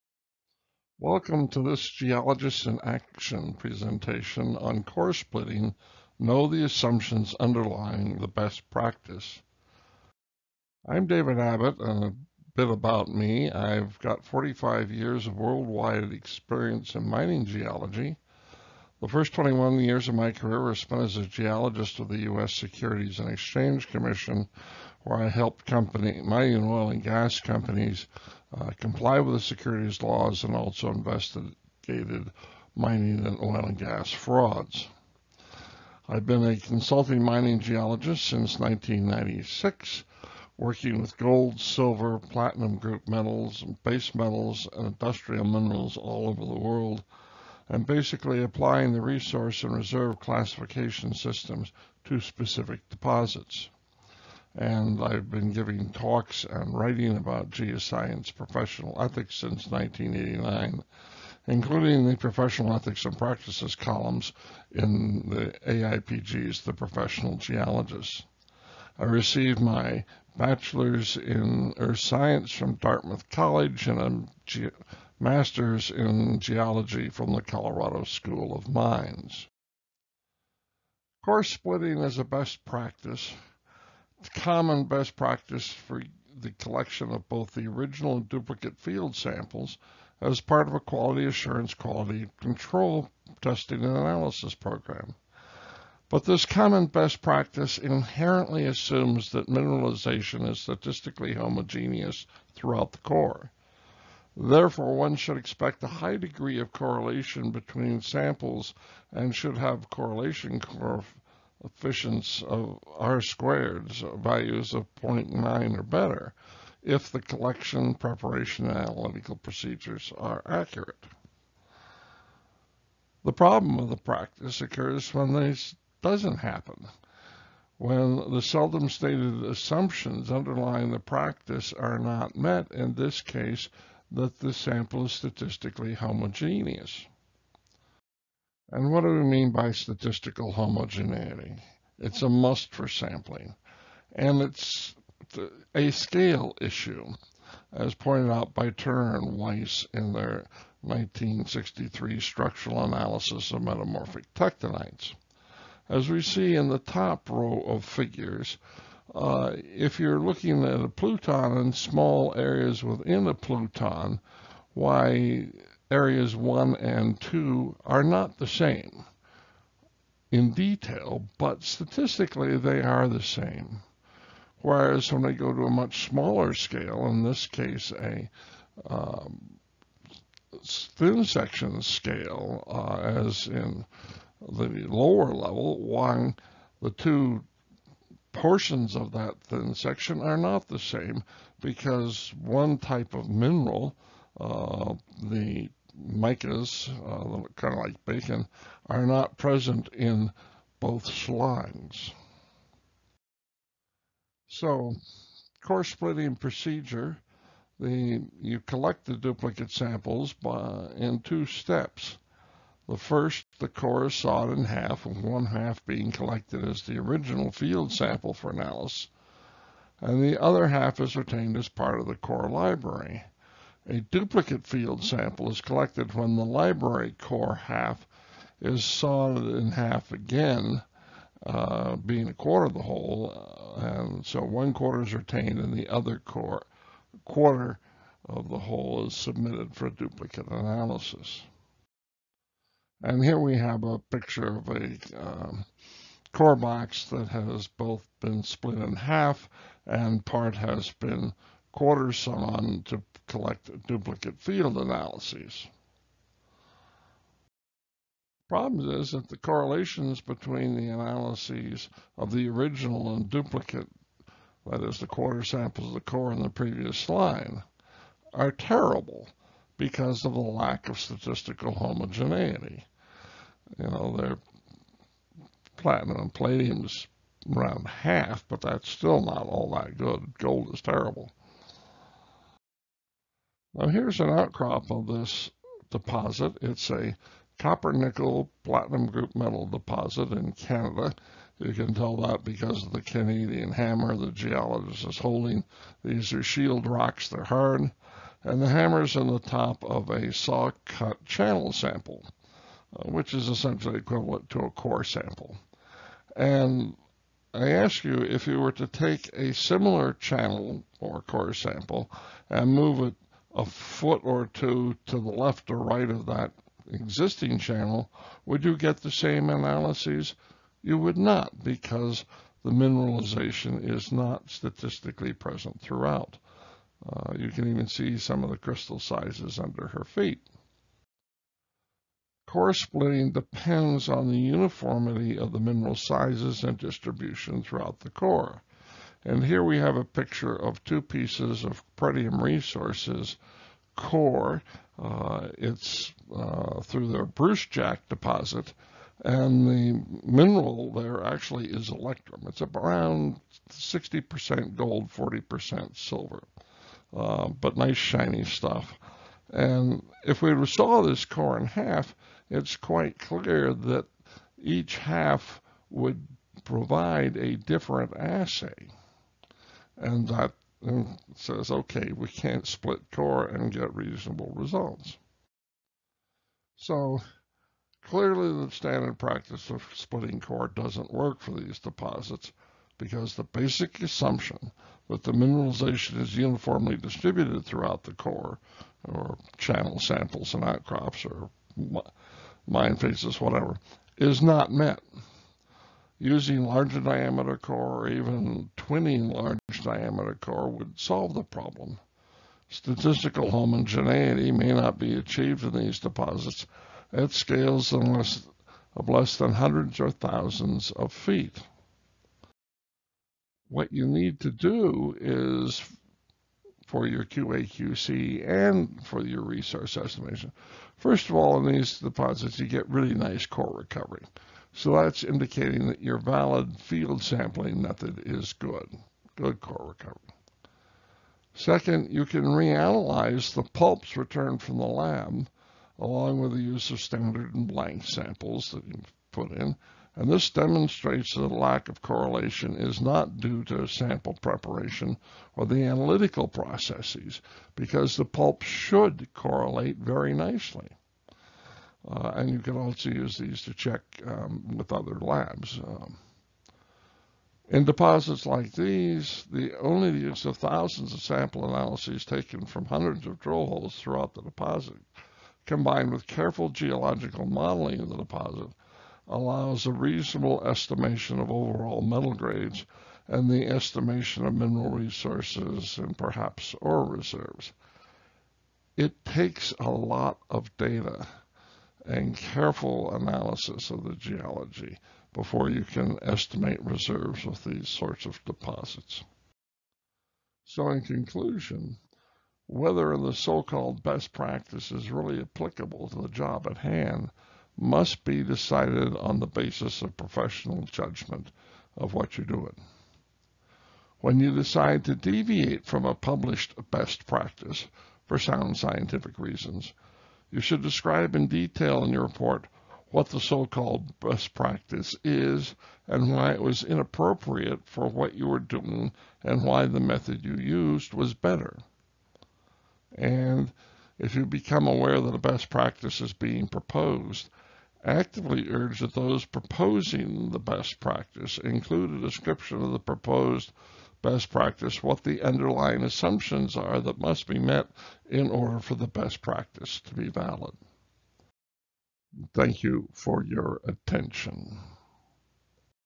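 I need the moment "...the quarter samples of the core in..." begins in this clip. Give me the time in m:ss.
4:24.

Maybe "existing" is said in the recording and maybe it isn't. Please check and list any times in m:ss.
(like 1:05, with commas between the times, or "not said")
5:16.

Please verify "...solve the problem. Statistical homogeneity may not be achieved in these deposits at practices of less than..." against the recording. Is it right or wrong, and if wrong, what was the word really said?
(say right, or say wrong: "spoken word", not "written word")
wrong: "scales", not "practices".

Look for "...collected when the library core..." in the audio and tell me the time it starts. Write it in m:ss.
3:45.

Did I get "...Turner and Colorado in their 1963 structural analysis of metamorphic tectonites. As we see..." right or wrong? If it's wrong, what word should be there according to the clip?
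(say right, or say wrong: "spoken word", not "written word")
wrong: "Weiss", not "Colorado".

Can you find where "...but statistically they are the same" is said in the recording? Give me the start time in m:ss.
2:51.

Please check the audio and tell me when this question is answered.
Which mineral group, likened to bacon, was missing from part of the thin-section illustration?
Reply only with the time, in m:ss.
3:15.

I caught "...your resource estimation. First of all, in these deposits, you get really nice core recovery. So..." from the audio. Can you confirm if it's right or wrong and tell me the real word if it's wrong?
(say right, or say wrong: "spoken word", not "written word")
right.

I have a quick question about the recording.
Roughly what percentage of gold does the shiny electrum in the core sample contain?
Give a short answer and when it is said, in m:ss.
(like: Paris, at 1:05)
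60%, at 5:53.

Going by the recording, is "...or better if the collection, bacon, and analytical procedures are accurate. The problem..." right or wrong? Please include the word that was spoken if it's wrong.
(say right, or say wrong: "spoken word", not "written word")
wrong: "preparation", not "bacon".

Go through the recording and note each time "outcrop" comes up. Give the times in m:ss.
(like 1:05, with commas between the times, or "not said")
4:44, 6:30.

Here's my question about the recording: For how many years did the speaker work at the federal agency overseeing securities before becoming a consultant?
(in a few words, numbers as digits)
21.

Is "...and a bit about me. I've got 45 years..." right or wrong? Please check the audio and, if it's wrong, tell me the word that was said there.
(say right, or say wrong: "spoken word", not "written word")
right.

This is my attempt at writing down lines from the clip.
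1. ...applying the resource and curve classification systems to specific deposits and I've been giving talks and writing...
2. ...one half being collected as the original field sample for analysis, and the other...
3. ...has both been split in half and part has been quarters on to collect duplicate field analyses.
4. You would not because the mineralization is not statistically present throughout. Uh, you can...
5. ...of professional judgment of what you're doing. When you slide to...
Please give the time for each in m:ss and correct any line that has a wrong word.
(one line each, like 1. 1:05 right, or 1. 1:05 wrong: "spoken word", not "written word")
1. 0:48 wrong: "reserve", not "curve"
2. 3:35 right
3. 4:07 right
4. 5:20 right
5. 8:20 wrong: "decide", not "slide".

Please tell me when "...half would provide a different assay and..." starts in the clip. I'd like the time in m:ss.
6:04.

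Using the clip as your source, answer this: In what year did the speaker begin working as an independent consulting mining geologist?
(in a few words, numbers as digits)
1996.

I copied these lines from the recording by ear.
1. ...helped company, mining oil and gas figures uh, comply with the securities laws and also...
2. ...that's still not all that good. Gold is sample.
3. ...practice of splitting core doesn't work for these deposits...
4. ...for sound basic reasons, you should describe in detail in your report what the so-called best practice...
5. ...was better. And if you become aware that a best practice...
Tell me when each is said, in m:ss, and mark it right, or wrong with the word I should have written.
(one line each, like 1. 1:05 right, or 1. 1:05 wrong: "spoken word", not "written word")
1. 0:25 wrong: "companies", not "figures"
2. 4:38 wrong: "terrible", not "sample"
3. 6:19 right
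4. 8:28 wrong: "scientific", not "basic"
5. 8:41 right.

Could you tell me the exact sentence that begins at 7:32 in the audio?
Uh, and you can also use these to check um, with other labs.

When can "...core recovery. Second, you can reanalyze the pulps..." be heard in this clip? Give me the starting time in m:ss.
7:09.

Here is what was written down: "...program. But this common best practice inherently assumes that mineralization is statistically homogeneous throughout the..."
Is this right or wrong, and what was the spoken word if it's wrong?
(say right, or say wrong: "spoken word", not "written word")
right.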